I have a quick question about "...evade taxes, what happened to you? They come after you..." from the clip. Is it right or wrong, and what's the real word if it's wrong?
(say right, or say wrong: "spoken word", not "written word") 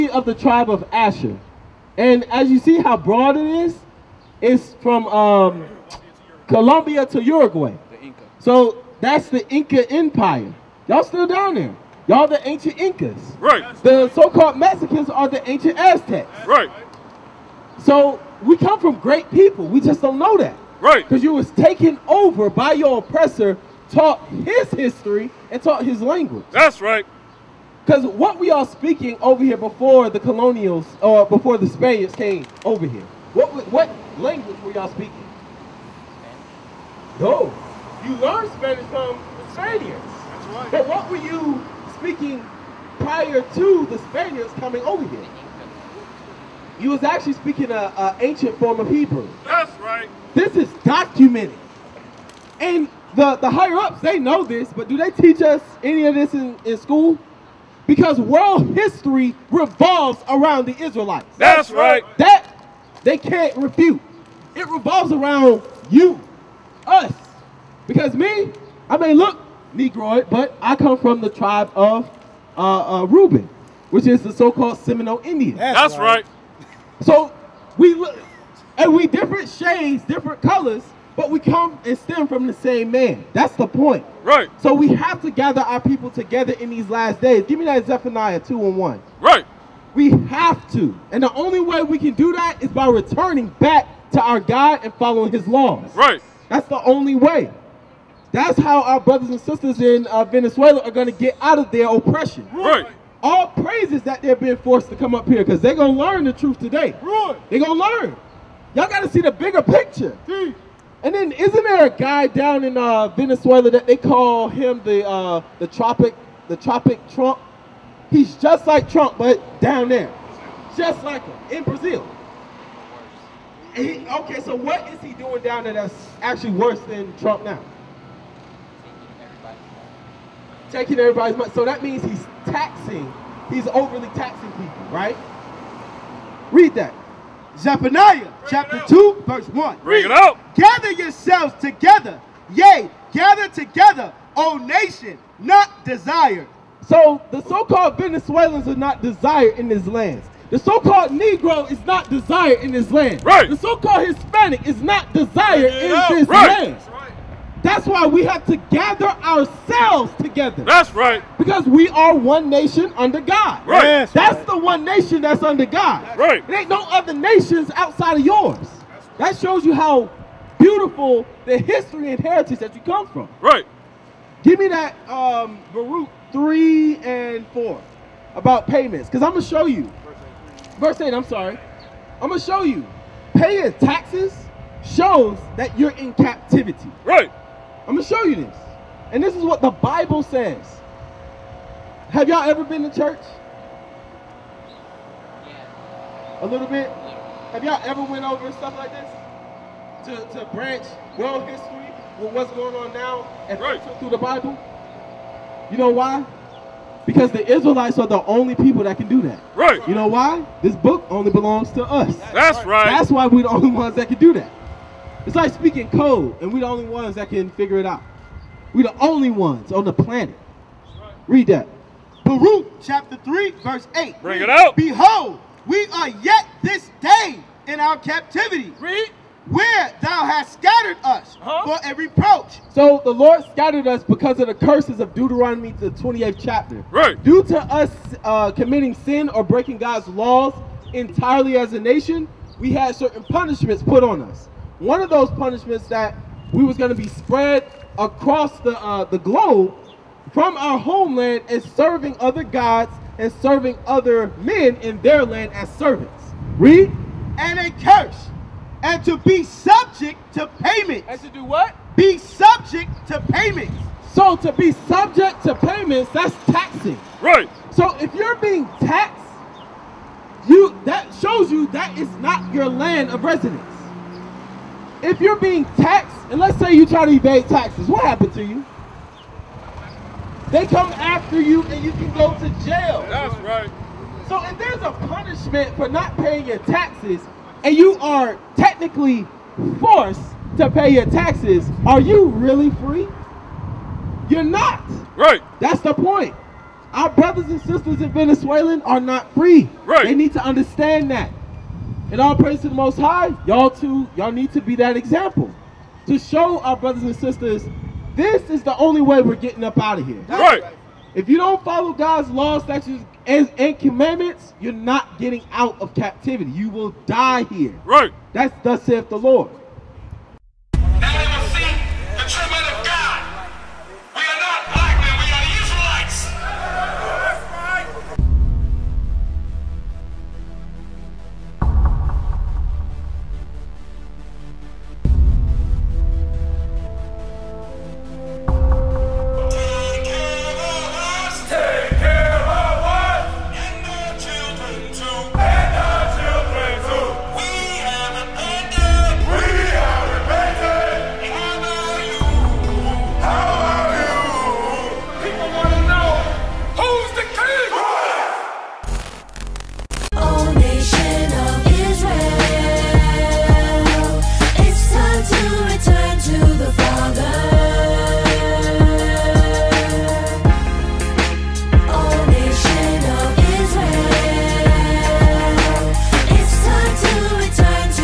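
right.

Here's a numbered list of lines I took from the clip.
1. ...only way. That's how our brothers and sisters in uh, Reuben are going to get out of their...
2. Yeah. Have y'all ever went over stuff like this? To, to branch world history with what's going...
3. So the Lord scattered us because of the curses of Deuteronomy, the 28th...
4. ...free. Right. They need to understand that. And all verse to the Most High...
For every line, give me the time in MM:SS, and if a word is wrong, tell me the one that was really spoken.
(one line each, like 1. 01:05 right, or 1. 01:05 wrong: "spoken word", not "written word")
1. 01:36 wrong: "Venezuela", not "Reuben"
2. 03:16 right
3. 03:52 right
4. 04:59 wrong: "praise", not "verse".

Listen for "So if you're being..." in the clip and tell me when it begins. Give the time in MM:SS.
04:27.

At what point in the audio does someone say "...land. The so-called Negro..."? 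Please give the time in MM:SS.
02:29.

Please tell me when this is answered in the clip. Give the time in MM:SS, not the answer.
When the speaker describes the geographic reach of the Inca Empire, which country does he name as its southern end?
00:07.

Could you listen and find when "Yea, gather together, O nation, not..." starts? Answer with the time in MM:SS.
02:22.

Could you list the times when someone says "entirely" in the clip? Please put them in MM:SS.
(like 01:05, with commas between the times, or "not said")
04:00.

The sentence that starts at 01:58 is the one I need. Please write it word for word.
He's just like Trump, but down there, just like him in Brazil.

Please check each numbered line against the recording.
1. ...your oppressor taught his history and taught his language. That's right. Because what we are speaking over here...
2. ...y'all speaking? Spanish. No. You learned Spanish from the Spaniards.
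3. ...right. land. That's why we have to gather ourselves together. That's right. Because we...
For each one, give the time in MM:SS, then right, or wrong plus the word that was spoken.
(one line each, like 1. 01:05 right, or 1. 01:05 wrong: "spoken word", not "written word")
1. 00:22 right
2. 00:34 right
3. 02:36 right.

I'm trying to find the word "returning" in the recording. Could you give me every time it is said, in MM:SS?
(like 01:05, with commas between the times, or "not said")
01:32.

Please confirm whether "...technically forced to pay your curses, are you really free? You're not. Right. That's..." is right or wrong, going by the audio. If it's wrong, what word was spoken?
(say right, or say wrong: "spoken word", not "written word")
wrong: "taxes", not "curses".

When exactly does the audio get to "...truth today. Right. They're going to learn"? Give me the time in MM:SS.
01:46.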